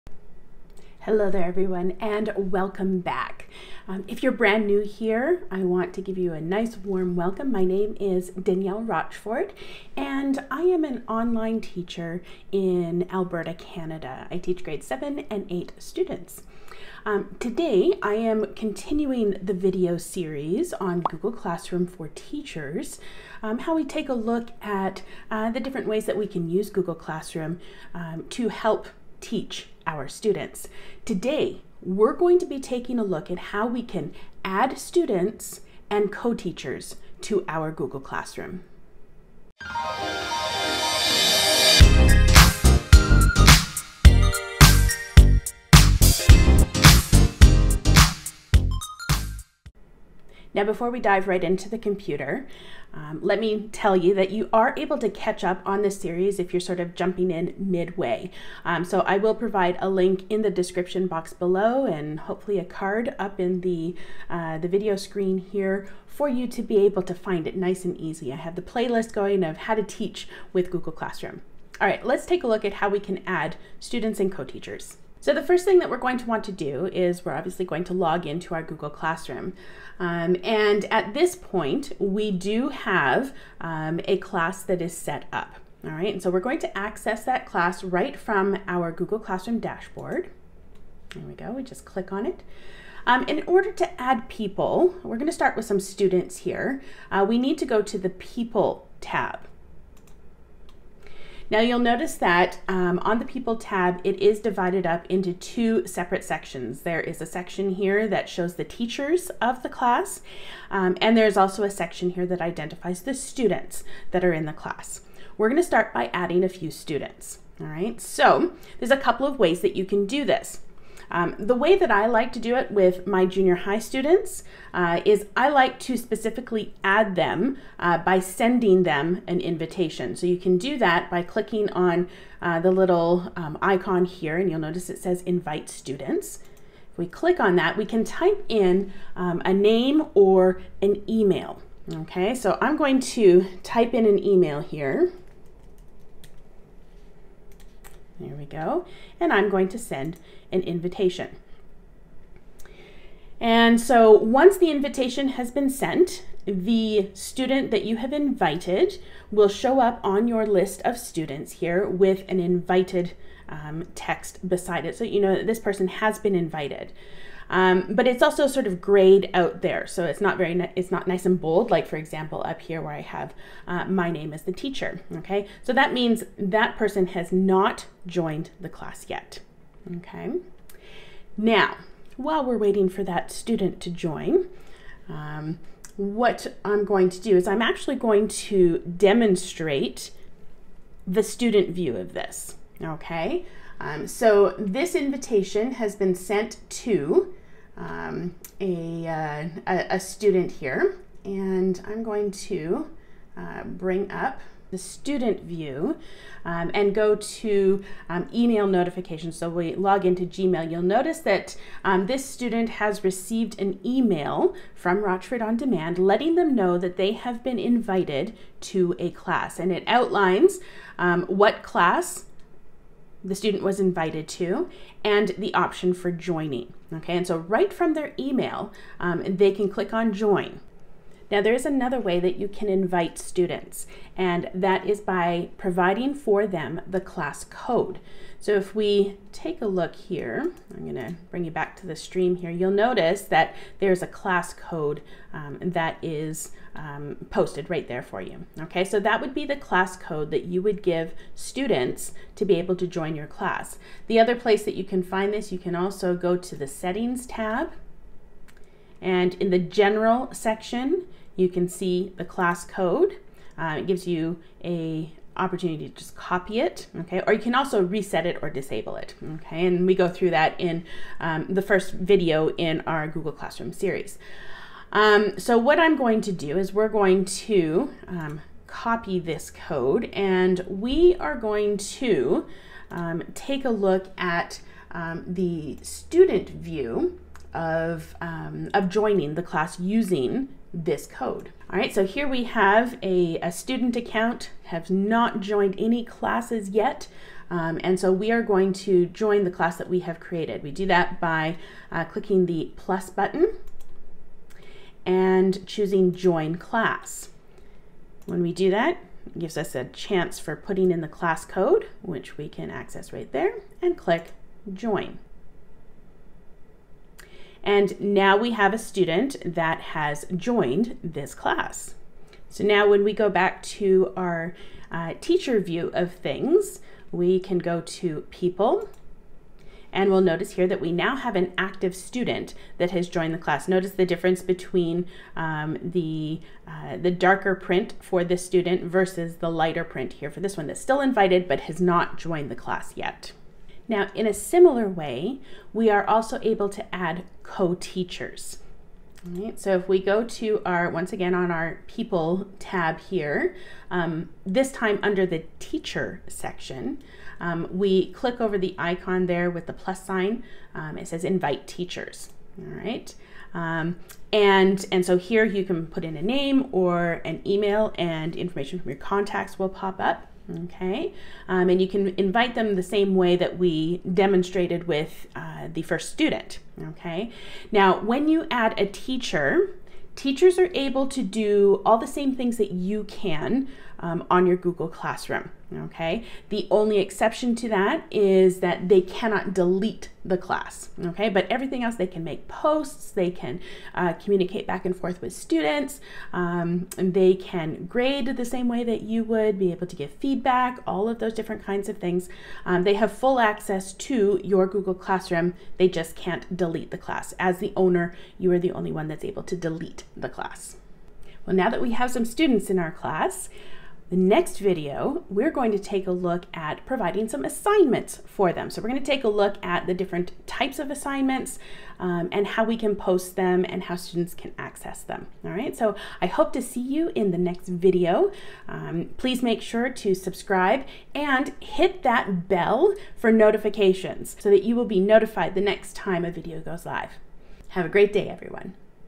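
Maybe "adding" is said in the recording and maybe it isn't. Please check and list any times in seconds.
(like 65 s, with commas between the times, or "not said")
116 s.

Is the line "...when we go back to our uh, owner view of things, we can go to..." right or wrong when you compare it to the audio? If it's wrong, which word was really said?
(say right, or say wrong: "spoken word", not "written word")
wrong: "teacher", not "owner".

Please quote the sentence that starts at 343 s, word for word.
Now, in a similar way, we are also able to add co-teachers.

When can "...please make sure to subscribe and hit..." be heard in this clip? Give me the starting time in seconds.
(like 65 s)
429 s.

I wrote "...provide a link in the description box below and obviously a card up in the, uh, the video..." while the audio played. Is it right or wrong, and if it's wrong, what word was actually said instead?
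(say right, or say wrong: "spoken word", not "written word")
wrong: "hopefully", not "obviously".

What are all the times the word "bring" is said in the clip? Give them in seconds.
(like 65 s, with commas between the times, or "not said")
203 s, 241 s.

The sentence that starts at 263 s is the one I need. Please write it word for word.
Uh, it gives you a opportunity to just copy it, okay?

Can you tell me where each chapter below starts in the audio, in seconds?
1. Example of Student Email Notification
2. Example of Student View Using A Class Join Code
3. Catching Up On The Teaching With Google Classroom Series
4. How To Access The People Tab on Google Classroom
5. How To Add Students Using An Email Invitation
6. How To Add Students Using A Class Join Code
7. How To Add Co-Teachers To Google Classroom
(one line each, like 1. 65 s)
1. 193 s
2. 291 s
3. 50 s
4. 95 s
5. 122 s
6. 231 s
7. 343 s.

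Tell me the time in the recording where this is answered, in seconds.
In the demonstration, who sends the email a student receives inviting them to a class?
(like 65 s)
215 s.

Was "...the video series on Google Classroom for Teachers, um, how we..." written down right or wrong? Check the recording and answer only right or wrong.
right.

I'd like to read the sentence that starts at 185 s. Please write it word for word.
Um, what I'm going to do is I'm actually going to demonstrate the student view of this.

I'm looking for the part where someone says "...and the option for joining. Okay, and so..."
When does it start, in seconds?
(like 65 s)
225 s.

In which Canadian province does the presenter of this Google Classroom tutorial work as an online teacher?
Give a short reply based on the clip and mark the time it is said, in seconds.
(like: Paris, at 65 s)
Alberta, at 13 s.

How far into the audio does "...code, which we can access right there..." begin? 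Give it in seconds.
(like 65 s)
311 s.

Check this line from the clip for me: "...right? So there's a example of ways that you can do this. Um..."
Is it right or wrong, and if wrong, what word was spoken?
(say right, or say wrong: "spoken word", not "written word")
wrong: "couple", not "example".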